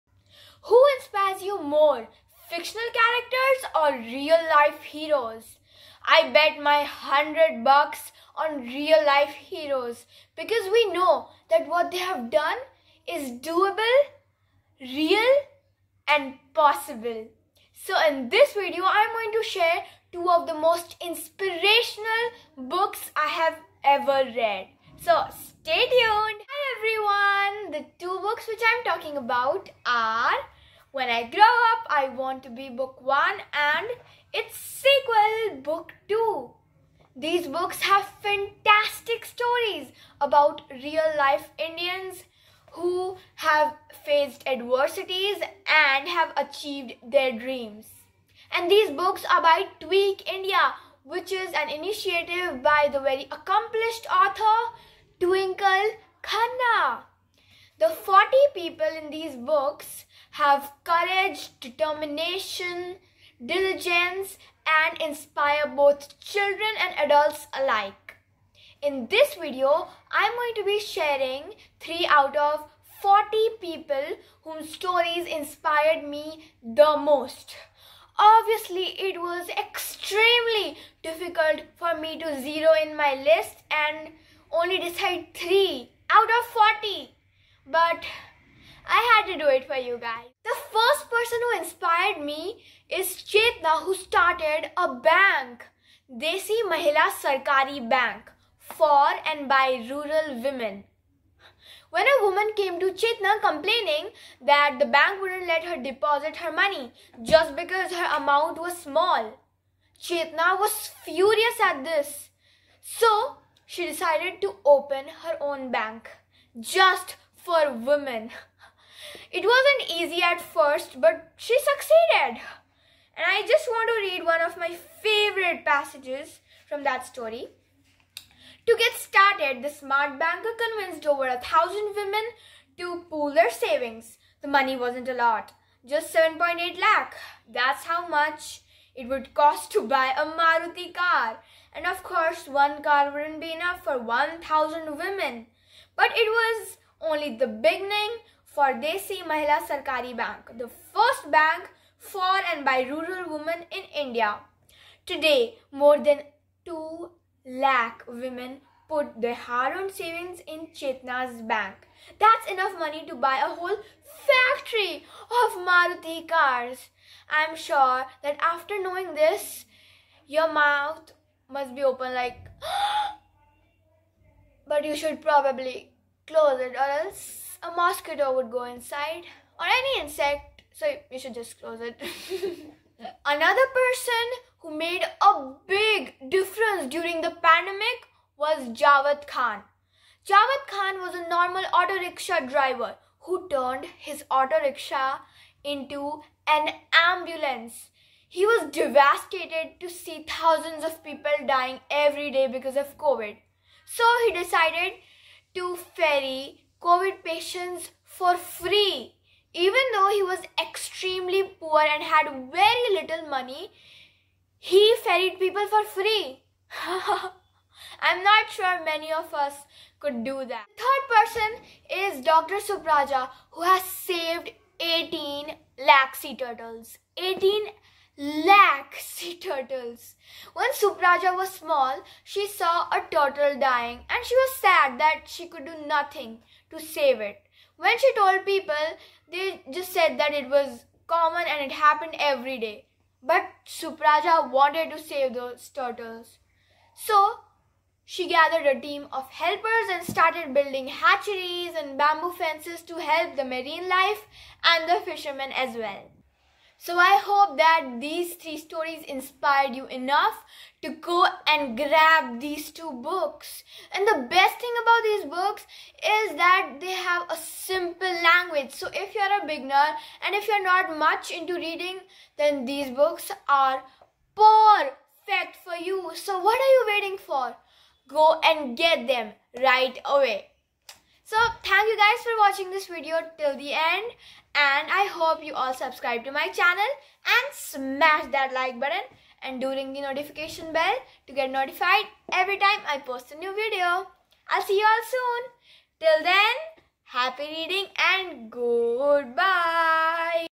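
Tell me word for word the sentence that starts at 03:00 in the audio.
So you should just close it.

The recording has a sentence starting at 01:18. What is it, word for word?
Obviously, it was extremely difficult for me to zero in my list and only decide 3 out of 40.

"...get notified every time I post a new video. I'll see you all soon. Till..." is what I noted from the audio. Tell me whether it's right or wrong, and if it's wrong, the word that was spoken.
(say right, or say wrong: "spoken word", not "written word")
right.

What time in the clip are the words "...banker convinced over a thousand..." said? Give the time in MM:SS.
02:10.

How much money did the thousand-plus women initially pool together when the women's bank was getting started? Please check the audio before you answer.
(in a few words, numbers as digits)
7.8 lakh.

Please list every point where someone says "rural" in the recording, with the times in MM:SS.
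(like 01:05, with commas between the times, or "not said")
01:39, 02:32.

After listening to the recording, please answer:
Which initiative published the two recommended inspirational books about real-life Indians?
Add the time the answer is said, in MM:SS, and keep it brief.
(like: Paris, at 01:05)
Tweak India, at 00:49.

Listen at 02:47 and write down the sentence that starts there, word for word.
I am sure that after knowing this, your mouth must be open like.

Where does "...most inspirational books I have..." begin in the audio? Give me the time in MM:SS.
00:20.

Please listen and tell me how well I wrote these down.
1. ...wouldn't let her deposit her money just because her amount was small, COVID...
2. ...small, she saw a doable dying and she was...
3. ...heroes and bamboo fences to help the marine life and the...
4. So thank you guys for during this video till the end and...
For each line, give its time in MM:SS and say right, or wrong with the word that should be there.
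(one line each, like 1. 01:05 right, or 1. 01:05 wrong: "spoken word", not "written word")
1. 01:45 wrong: "Chetna", not "COVID"
2. 03:51 wrong: "turtle", not "doable"
3. 04:10 wrong: "hatcheries", not "heroes"
4. 04:41 wrong: "watching", not "during".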